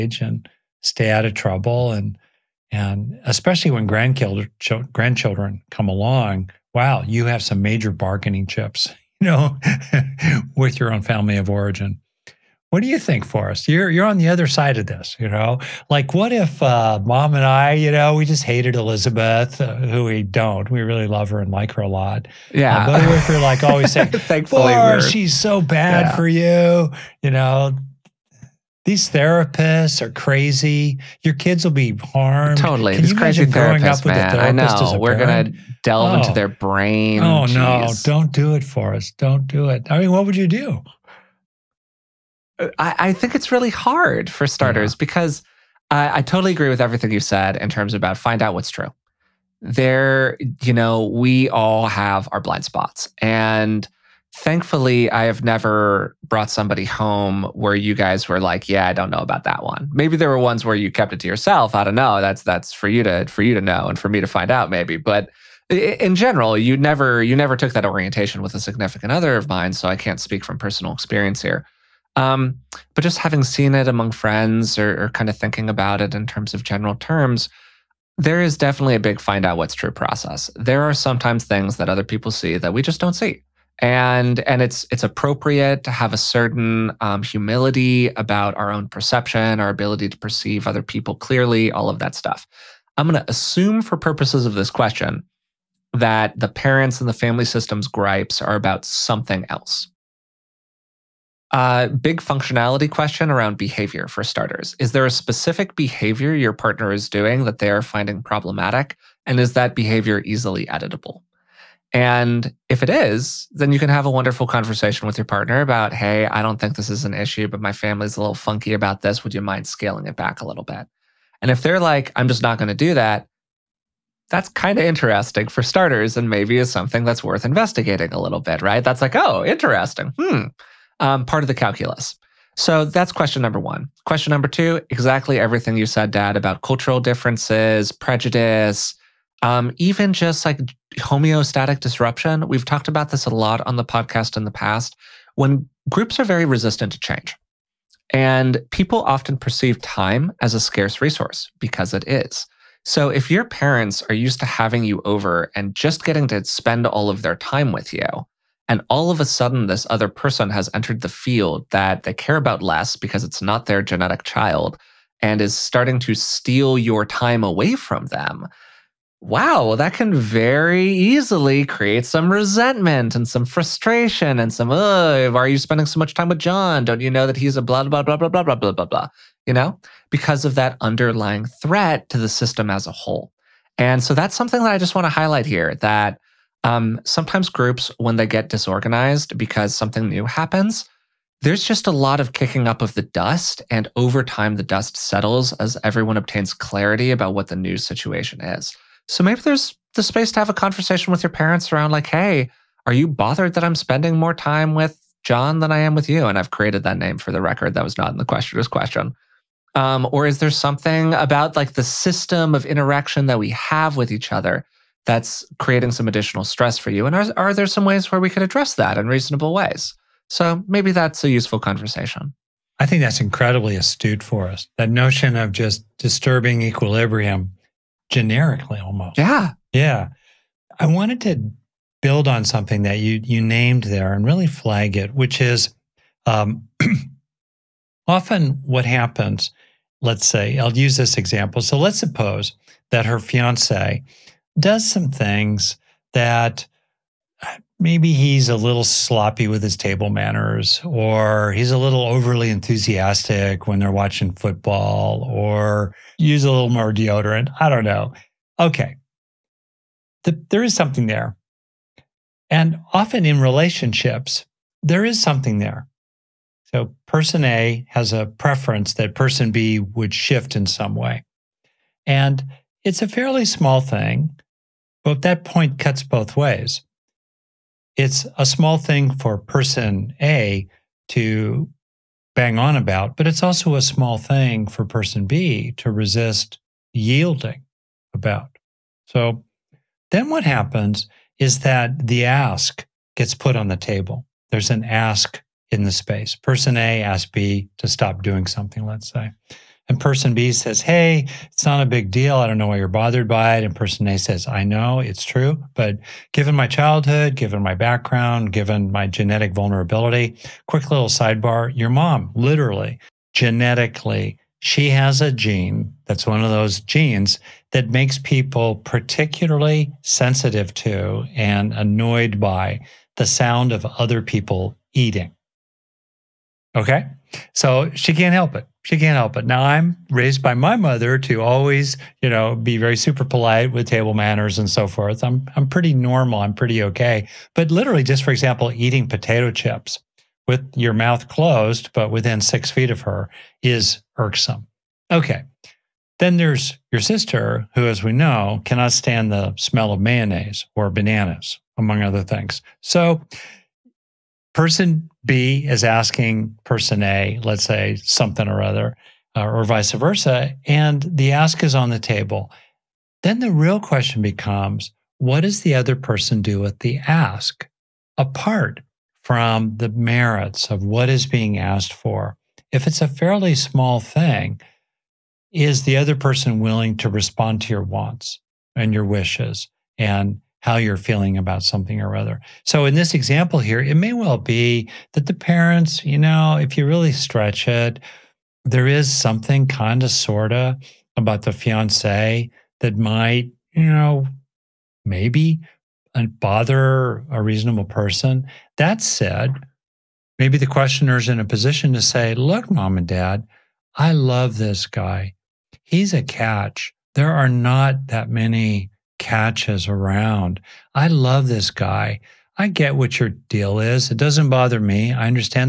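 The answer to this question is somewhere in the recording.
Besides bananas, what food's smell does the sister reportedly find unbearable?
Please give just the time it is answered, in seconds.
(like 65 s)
349 s.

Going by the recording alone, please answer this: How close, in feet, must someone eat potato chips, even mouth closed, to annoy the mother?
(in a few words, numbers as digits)
6.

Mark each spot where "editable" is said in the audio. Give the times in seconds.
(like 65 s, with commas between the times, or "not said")
110 s.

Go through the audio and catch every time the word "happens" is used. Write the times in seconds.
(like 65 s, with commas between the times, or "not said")
190 s, 238 s, 290 s.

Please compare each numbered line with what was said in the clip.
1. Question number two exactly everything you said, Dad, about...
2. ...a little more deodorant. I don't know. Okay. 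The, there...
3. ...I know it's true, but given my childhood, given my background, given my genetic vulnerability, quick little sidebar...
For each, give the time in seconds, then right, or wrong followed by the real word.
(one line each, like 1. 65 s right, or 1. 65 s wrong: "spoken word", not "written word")
1. 134 s right
2. 256 s right
3. 304 s right.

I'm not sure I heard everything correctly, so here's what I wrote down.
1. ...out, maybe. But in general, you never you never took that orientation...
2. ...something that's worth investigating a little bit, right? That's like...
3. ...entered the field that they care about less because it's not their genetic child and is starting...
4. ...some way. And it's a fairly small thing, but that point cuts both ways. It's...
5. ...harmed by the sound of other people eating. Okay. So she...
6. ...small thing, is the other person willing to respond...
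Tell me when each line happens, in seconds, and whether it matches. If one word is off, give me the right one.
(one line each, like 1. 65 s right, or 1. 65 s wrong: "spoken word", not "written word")
1. 64 s right
2. 126 s right
3. 160 s right
4. 270 s right
5. 321 s wrong: "annoyed", not "harmed"
6. 373 s right.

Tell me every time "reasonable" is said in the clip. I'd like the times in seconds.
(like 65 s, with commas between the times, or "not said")
219 s, 397 s.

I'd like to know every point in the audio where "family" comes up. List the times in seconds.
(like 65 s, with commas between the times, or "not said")
11 s, 97 s, 117 s.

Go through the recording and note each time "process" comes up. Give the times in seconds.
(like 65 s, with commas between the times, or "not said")
79 s.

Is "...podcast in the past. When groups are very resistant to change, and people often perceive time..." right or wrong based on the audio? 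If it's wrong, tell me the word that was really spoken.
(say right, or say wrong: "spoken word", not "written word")
right.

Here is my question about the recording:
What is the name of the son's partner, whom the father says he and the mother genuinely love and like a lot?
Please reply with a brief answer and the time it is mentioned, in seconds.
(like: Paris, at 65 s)
Elizabeth, at 18 s.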